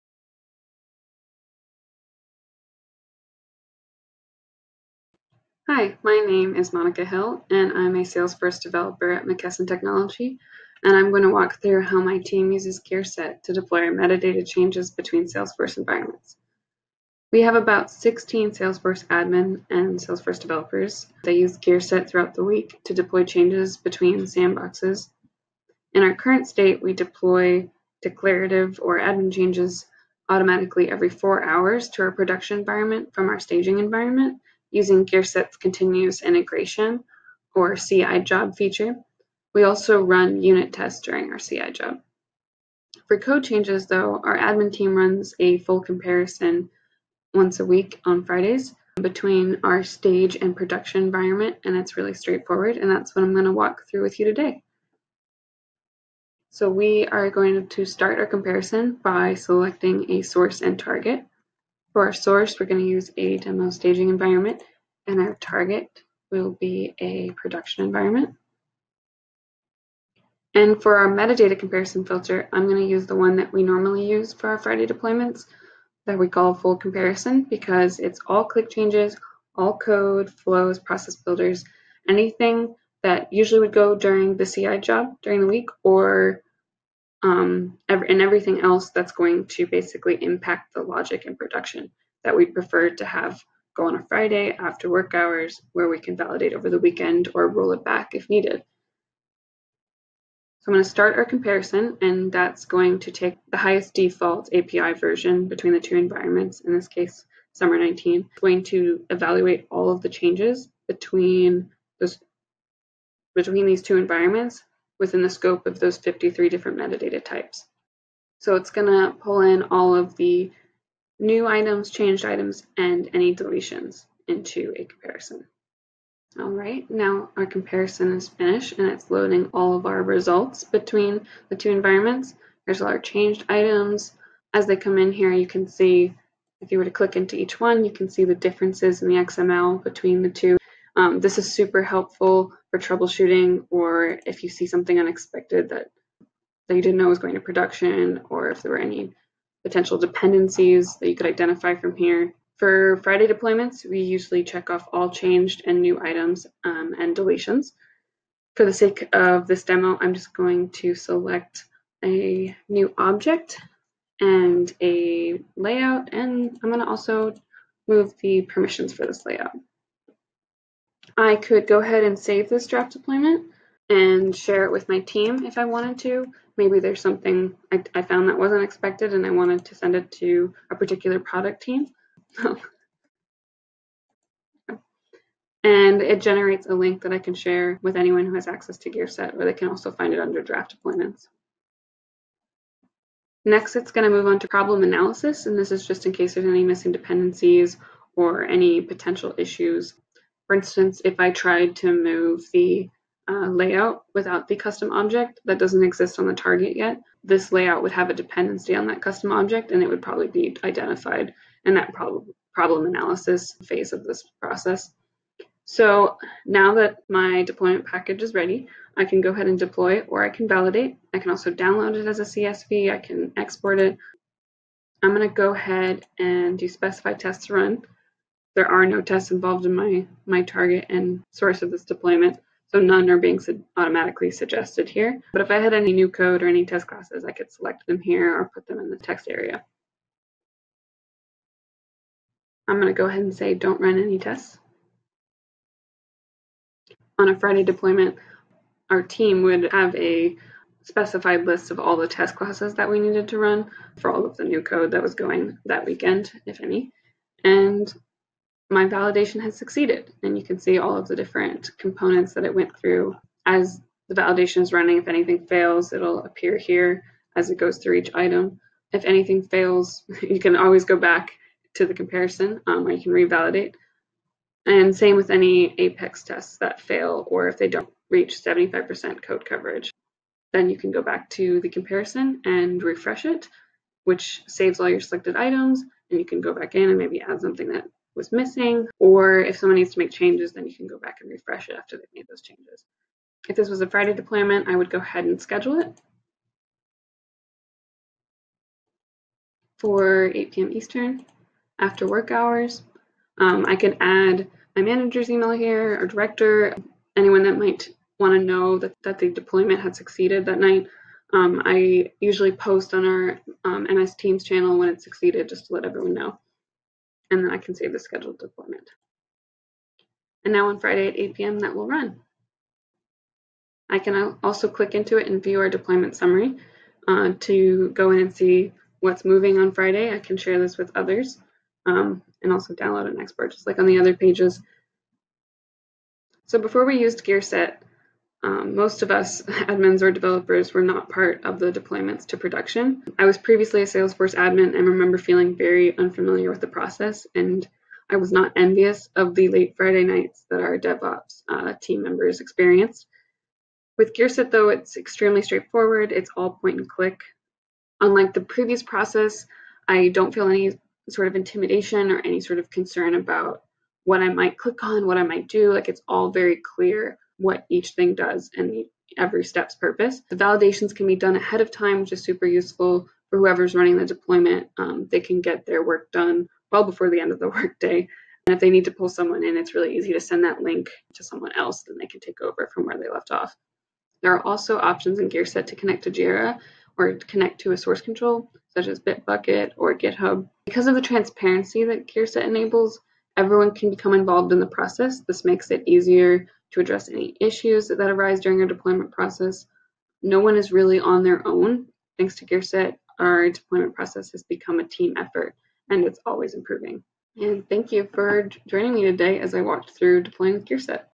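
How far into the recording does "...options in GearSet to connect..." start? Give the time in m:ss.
6:24.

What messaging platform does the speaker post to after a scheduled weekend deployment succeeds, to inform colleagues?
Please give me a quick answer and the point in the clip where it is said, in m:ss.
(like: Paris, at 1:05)
MS Teams, at 5:13.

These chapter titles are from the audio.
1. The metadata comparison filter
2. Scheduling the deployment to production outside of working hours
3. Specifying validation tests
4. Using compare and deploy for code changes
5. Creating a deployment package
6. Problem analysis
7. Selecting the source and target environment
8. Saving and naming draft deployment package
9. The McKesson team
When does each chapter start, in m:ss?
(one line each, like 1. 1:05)
1. 1:08
2. 4:53
3. 3:36
4. 0:42
5. 2:06
6. 3:12
7. 0:54
8. 2:51
9. 0:16.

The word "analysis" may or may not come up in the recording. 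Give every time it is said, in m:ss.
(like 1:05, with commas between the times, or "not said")
3:14, 3:32.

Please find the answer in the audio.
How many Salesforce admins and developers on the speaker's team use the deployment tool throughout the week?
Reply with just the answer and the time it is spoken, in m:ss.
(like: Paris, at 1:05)
16, at 0:17.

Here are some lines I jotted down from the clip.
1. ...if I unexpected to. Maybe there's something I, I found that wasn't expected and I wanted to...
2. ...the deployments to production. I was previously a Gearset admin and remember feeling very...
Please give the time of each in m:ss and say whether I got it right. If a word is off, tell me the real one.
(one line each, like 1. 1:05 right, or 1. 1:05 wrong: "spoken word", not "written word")
1. 2:55 wrong: "wanted", not "unexpected"
2. 5:41 wrong: "Salesforce", not "Gearset".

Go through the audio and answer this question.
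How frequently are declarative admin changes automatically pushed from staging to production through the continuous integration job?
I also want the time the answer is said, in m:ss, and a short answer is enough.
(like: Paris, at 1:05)
every 4 hours, at 0:30.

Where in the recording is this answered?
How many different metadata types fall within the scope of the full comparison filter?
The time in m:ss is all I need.
1:55.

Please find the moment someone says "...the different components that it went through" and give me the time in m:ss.
4:21.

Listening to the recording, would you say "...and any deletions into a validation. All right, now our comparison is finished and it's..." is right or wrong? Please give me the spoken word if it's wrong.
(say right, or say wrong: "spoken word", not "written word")
wrong: "comparison", not "validation".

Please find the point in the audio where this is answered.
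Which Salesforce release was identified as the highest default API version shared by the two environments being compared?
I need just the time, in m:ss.
1:47.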